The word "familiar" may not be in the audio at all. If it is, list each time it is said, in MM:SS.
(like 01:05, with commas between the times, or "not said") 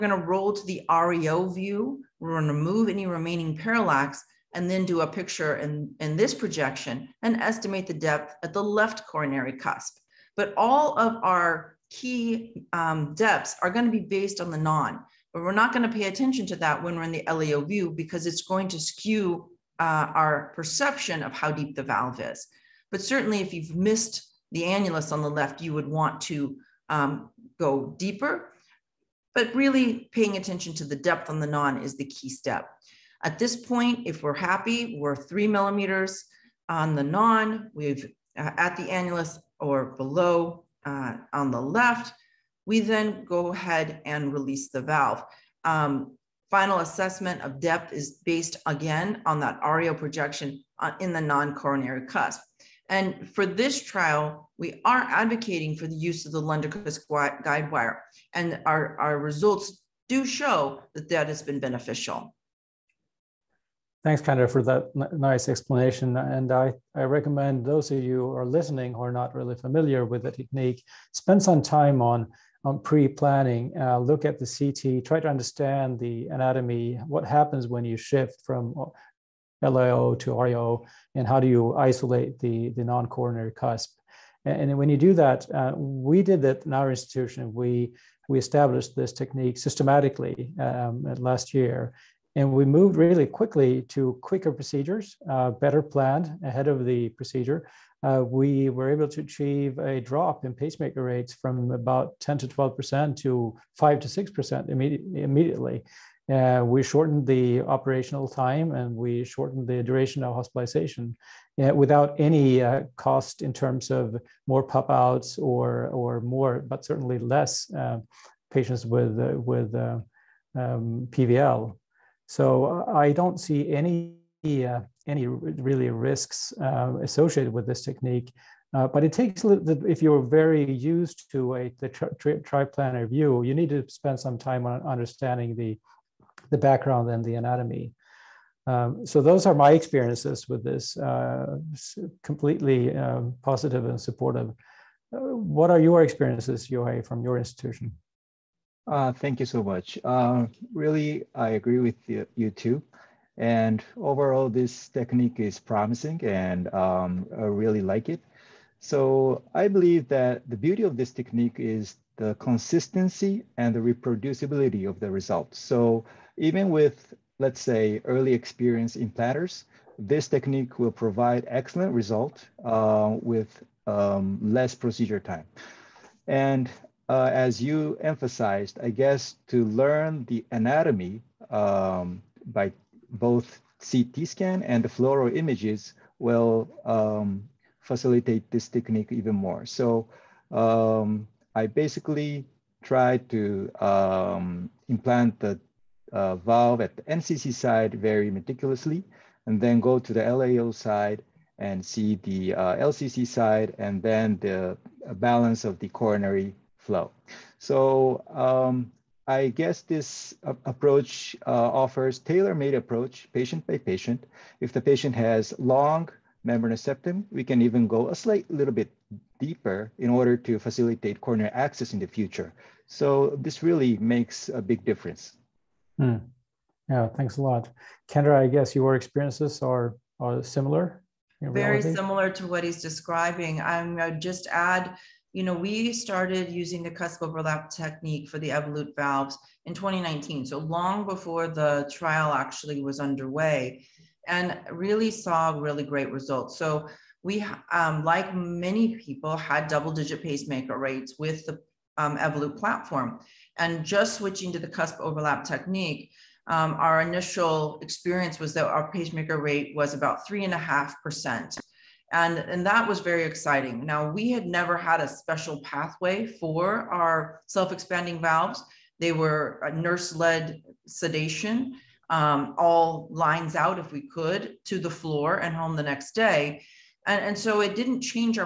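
01:09.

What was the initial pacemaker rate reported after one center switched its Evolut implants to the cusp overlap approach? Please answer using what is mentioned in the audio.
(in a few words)
3.5%.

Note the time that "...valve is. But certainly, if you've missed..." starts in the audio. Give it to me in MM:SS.
00:21.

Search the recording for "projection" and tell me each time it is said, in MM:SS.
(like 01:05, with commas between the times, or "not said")
00:06, 00:49.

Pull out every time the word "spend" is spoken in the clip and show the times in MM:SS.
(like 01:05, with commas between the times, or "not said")
01:11, 02:13.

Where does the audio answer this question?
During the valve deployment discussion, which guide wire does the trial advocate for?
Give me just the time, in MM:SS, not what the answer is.
00:56.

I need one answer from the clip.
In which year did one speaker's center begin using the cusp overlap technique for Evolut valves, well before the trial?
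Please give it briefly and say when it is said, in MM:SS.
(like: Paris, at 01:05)
2019, at 03:59.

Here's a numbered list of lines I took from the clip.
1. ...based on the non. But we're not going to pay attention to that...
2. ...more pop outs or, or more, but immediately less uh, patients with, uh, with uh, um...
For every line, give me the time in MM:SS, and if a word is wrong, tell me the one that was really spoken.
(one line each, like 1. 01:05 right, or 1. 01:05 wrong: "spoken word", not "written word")
1. 00:14 right
2. 01:54 wrong: "certainly", not "immediately".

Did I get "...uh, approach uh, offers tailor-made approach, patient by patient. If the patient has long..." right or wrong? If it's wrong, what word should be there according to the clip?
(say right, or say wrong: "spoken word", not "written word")
right.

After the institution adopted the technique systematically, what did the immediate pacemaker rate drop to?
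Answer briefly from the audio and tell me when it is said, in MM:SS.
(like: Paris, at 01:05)
5 to 6%, at 01:43.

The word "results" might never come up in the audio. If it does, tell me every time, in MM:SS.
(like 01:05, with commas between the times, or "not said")
00:59, 02:45, 02:51, 04:06.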